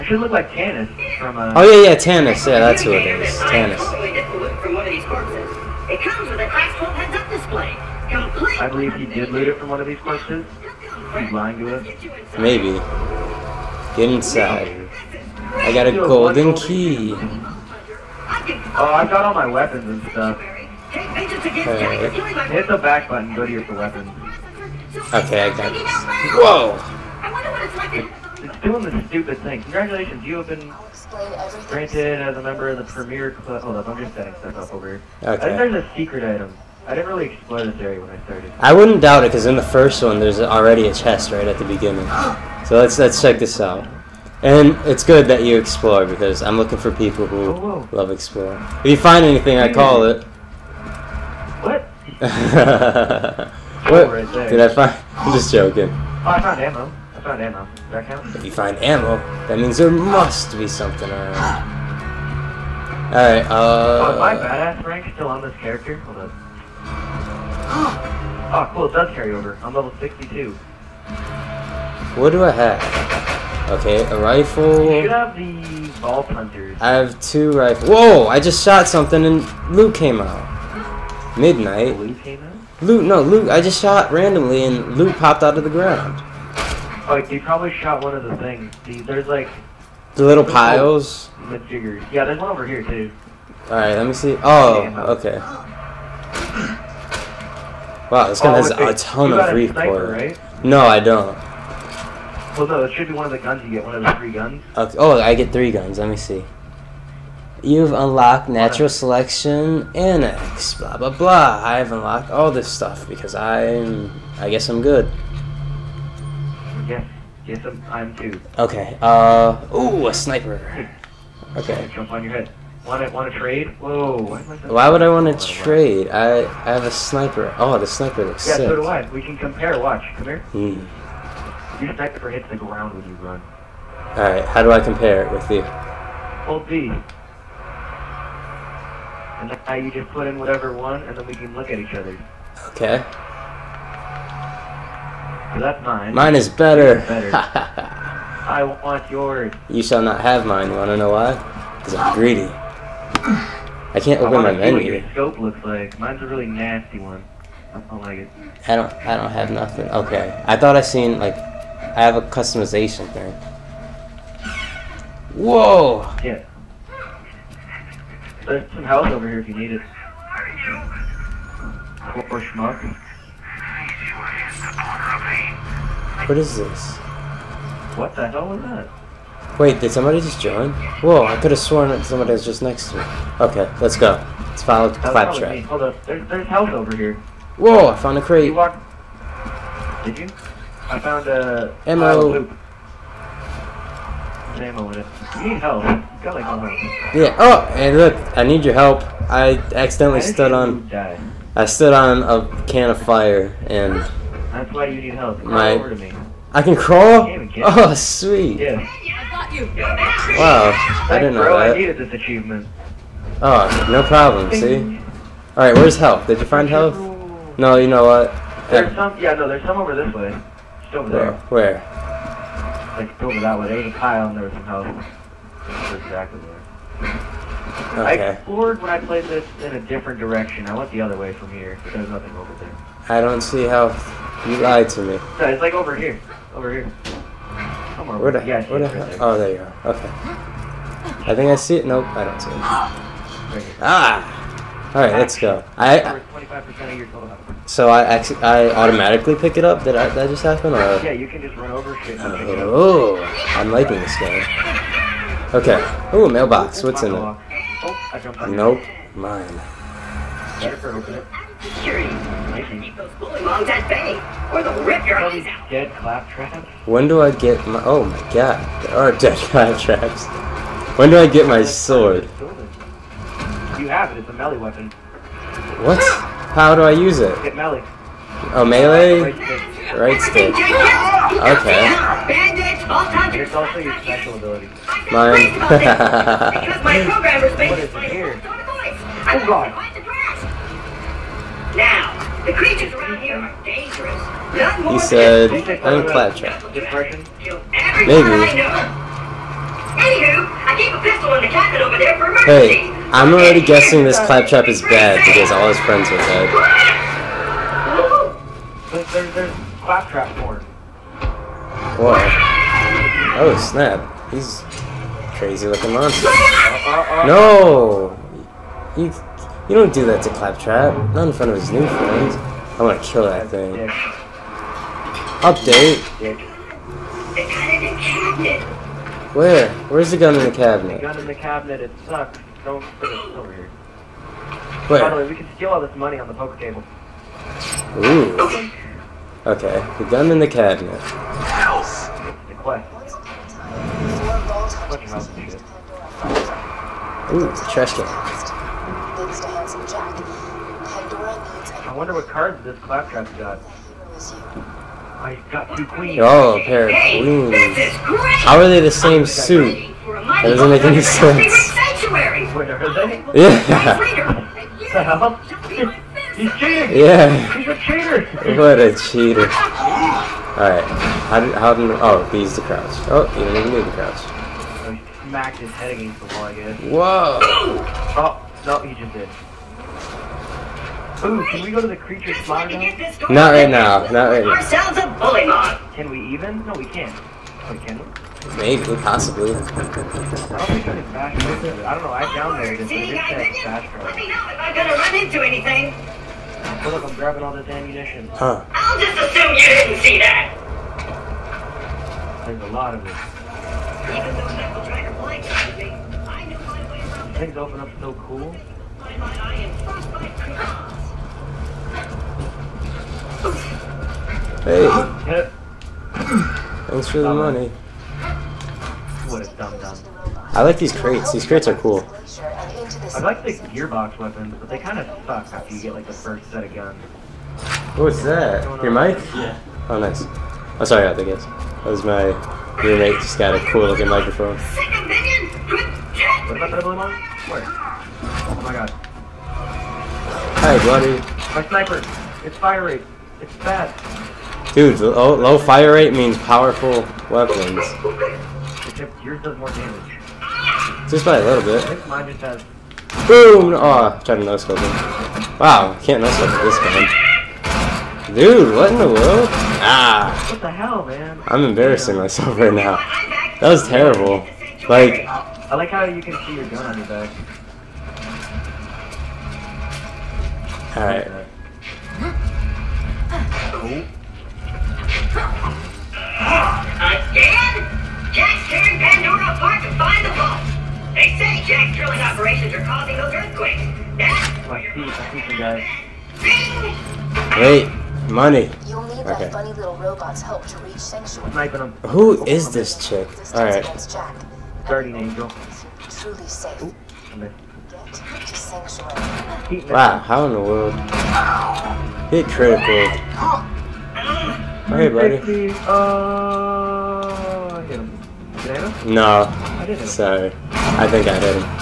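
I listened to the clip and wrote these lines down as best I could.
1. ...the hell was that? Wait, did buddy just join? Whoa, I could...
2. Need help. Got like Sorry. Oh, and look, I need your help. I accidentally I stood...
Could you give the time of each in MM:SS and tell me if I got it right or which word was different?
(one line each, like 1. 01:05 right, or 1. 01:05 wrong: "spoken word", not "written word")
1. 02:58 wrong: "somebody", not "buddy"
2. 03:15 wrong: "Yeah", not "Sorry".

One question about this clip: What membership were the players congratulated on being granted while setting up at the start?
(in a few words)
Premiere Club.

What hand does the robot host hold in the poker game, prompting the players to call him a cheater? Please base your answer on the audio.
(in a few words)
A pair of queens.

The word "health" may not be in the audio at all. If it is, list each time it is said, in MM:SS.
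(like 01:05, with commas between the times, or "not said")
02:48, 03:06.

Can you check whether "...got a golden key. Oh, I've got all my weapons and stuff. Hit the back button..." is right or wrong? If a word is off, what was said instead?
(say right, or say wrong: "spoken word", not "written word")
right.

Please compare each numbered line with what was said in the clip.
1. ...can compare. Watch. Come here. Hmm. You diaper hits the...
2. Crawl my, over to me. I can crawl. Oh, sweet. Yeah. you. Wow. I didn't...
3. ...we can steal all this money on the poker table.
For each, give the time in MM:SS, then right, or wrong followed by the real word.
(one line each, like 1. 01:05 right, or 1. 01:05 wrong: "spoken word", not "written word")
1. 02:09 right
2. 03:25 right
3. 05:35 right.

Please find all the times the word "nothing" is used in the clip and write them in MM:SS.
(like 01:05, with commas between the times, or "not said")
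02:39, 03:52.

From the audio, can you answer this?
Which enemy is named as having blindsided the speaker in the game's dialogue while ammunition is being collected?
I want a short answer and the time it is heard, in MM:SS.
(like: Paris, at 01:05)
Knuckle Dragger, at 06:44.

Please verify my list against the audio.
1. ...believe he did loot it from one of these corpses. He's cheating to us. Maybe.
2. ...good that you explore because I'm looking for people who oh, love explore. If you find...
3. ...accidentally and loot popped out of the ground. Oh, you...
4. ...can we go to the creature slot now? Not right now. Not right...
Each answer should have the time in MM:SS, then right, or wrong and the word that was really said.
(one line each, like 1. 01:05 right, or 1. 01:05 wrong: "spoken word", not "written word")
1. 00:08 wrong: "lying", not "cheating"
2. 00:45 right
3. 01:24 wrong: "randomly", not "accidentally"
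4. 06:21 right.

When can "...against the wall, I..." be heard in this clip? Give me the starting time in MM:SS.
06:15.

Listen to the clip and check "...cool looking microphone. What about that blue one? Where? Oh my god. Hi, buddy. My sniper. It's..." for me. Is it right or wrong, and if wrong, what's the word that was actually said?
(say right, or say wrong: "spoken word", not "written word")
right.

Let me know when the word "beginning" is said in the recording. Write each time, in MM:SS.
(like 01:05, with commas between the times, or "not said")
00:41.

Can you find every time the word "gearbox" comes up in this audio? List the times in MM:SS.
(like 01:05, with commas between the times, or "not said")
07:03.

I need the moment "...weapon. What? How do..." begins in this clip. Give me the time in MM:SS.
04:34.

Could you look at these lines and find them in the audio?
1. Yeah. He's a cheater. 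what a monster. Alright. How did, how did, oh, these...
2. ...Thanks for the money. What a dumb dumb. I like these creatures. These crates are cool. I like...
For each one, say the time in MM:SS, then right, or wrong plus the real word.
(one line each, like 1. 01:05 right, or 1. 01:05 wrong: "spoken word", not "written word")
1. 06:06 wrong: "cheater", not "monster"
2. 06:56 wrong: "crates", not "creatures".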